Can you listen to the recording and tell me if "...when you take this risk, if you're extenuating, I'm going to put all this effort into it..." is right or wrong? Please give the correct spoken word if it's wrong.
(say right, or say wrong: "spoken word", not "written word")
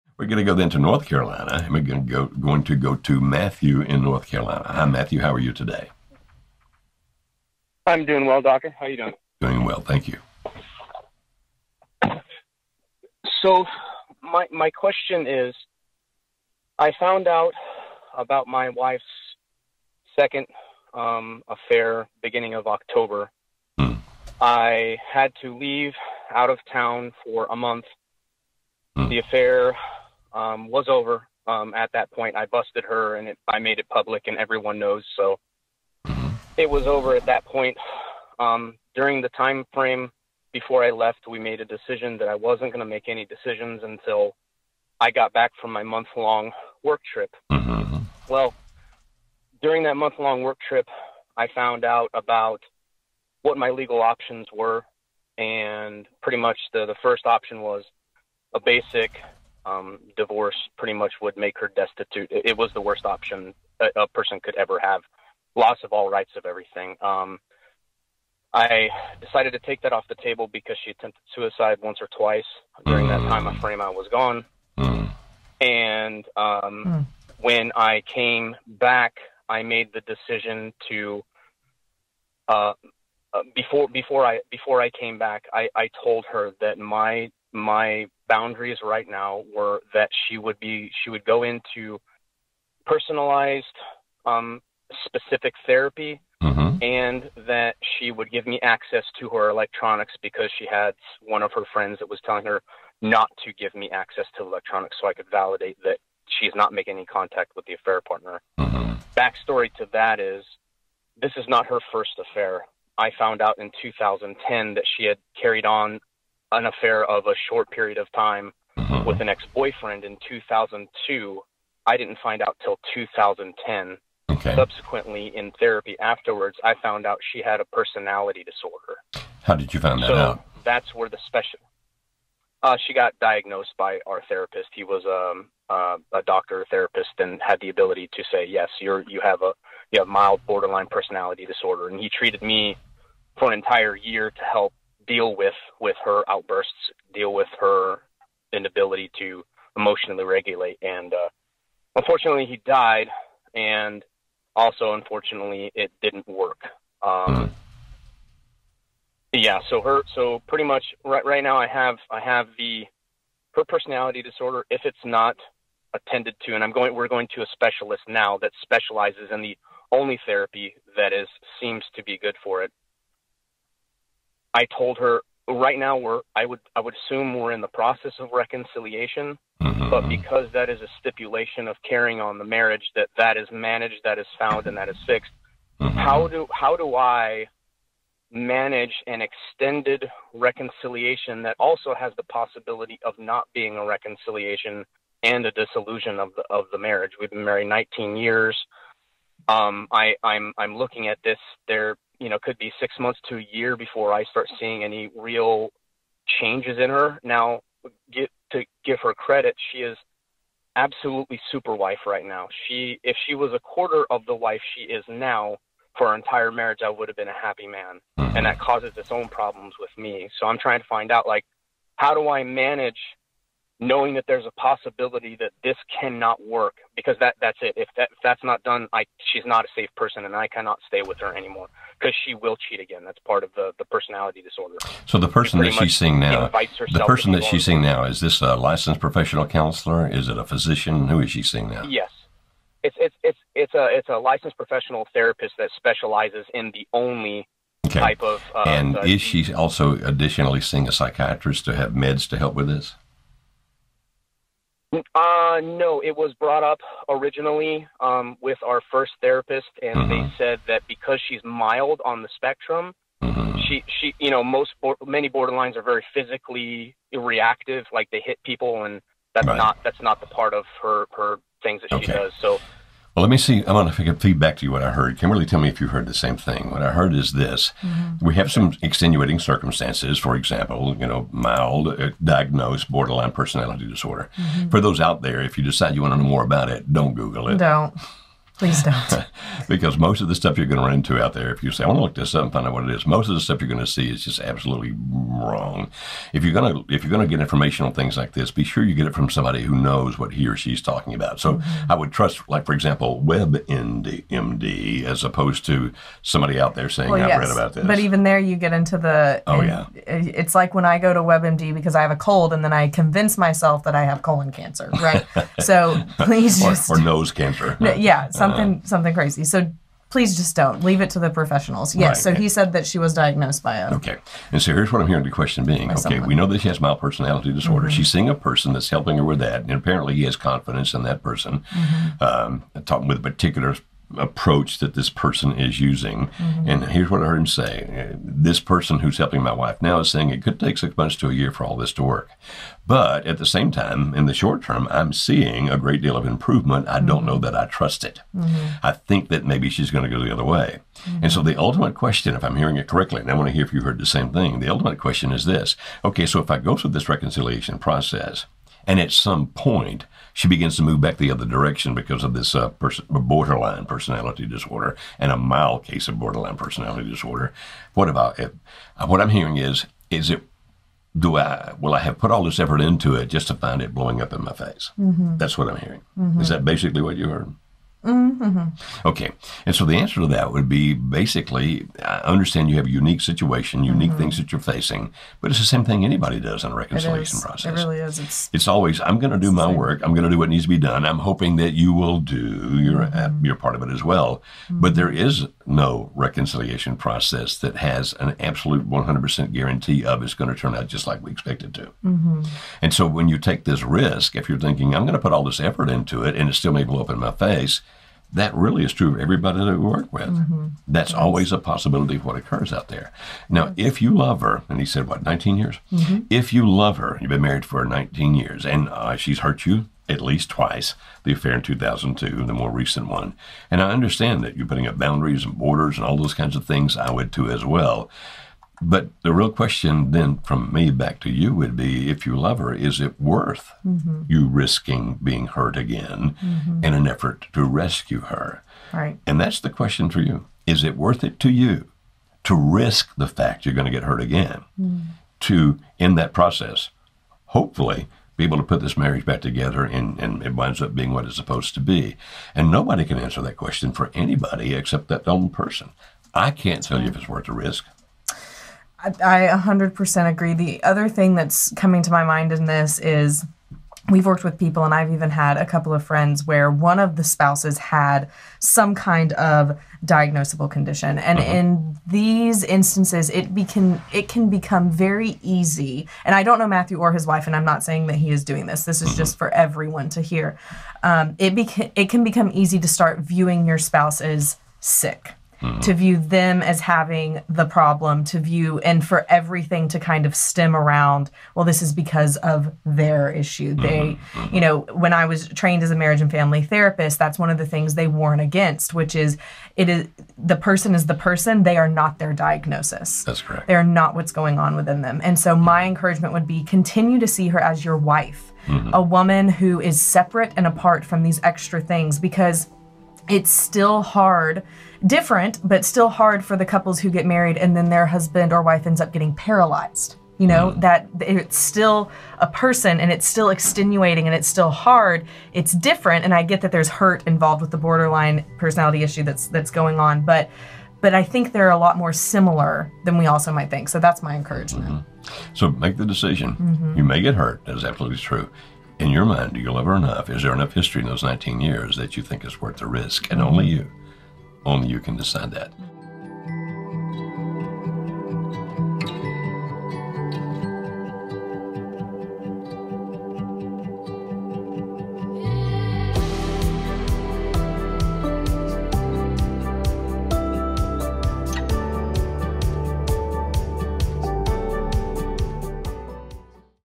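wrong: "thinking", not "extenuating".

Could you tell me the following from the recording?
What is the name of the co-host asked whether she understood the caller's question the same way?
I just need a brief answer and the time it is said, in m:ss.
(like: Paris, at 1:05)
Kimberly, at 4:35.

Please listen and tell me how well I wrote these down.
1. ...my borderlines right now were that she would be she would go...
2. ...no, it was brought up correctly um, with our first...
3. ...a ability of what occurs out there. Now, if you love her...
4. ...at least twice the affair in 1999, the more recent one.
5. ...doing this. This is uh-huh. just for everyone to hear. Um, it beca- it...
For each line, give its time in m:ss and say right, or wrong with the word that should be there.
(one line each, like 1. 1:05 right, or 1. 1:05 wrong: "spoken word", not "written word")
1. 1:27 wrong: "boundaries", not "borderlines"
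2. 4:15 wrong: "originally", not "correctly"
3. 6:51 wrong: "possibility", not "ability"
4. 7:00 wrong: "2002", not "1999"
5. 7:58 right.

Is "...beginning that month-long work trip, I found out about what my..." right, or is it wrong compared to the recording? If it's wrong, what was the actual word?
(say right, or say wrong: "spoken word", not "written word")
wrong: "during", not "beginning".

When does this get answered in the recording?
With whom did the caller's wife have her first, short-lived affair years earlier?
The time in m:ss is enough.
1:59.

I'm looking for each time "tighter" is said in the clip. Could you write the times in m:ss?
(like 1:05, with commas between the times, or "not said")
not said.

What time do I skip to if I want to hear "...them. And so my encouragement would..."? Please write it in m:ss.
8:25.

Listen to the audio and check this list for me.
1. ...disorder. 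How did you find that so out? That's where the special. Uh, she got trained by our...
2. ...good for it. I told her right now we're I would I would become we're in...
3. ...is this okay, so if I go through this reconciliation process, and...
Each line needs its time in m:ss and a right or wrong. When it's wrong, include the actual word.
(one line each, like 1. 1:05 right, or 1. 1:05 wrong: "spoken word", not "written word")
1. 2:08 wrong: "diagnosed", not "trained"
2. 2:52 wrong: "assume", not "become"
3. 5:55 right.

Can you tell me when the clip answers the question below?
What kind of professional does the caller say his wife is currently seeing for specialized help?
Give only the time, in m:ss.
4:04.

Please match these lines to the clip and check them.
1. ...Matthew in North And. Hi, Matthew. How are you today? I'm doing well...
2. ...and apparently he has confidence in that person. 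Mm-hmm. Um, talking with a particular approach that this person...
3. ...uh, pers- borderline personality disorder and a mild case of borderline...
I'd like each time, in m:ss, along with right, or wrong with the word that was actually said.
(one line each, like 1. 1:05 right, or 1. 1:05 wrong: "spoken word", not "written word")
1. 0:03 wrong: "Carolina", not "And"
2. 5:29 right
3. 6:02 right.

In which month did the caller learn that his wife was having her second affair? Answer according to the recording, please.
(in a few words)
October.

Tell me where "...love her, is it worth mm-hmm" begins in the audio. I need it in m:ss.
7:12.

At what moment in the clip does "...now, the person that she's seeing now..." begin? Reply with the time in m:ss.
3:56.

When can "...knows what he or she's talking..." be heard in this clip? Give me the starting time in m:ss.
4:59.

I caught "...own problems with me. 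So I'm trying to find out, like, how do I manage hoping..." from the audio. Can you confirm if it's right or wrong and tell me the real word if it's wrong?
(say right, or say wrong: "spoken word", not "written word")
wrong: "knowing", not "hoping".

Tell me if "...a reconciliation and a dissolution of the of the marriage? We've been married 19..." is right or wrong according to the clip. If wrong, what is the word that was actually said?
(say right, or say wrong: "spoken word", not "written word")
right.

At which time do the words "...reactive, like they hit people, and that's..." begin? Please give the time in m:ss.
4:27.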